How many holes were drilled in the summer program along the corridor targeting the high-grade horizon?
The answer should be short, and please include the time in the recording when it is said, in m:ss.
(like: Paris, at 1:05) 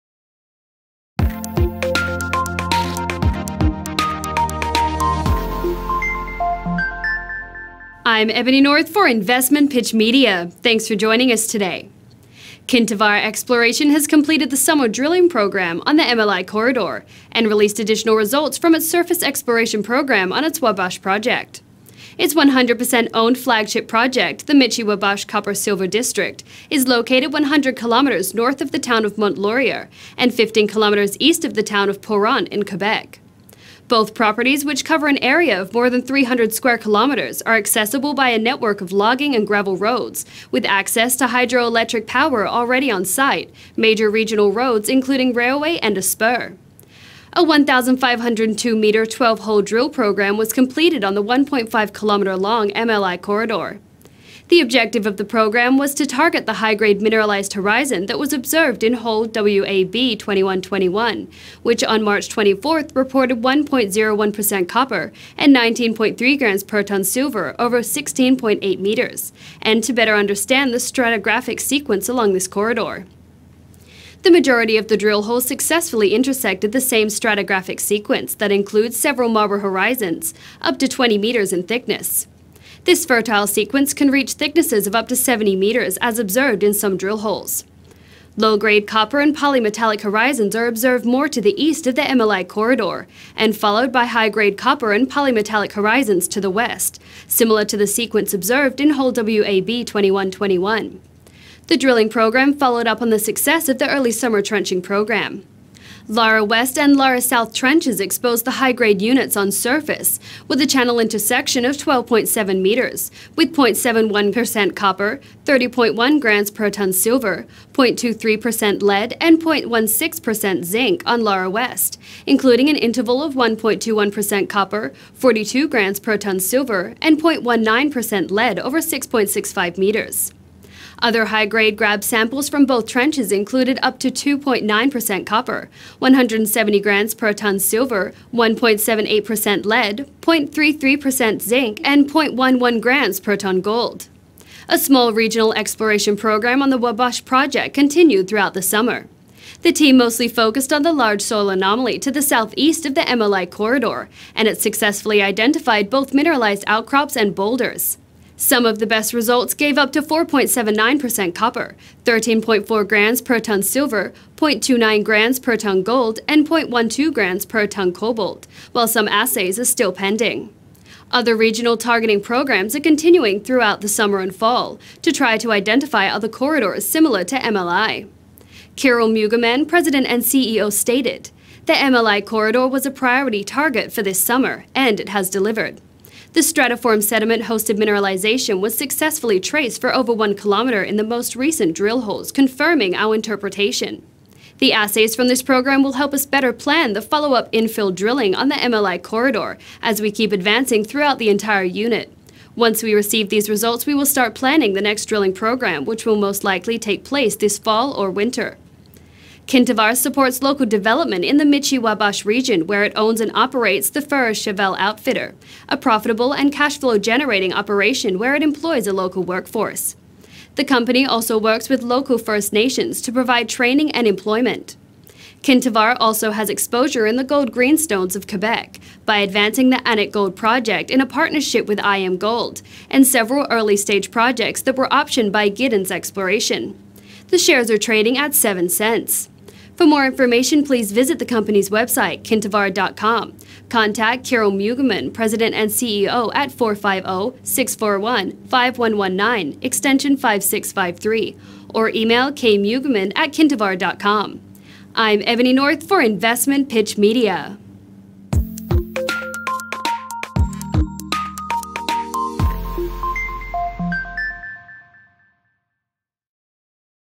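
12, at 0:49.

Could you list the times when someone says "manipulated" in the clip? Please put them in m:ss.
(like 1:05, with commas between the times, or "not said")
not said.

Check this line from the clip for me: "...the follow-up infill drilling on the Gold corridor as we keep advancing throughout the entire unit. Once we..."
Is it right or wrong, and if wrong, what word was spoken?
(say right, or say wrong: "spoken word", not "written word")
wrong: "MLI", not "Gold".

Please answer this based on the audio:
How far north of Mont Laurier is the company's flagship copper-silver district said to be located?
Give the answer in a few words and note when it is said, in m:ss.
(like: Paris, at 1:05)
100 kilometers, at 0:27.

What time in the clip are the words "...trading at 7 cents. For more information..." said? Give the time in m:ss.
3:57.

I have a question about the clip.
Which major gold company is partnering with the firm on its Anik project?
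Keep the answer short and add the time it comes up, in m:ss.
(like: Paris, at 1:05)
IAMGOLD, at 3:51.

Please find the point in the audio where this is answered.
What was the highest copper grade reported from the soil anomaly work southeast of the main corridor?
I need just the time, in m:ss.
2:40.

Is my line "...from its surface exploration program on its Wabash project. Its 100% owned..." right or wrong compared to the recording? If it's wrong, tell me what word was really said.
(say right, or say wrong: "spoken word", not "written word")
right.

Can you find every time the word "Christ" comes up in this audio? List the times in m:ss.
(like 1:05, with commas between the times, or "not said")
not said.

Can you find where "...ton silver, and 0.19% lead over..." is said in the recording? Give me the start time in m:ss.
2:06.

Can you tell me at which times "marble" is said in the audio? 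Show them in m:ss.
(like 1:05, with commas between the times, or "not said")
1:19.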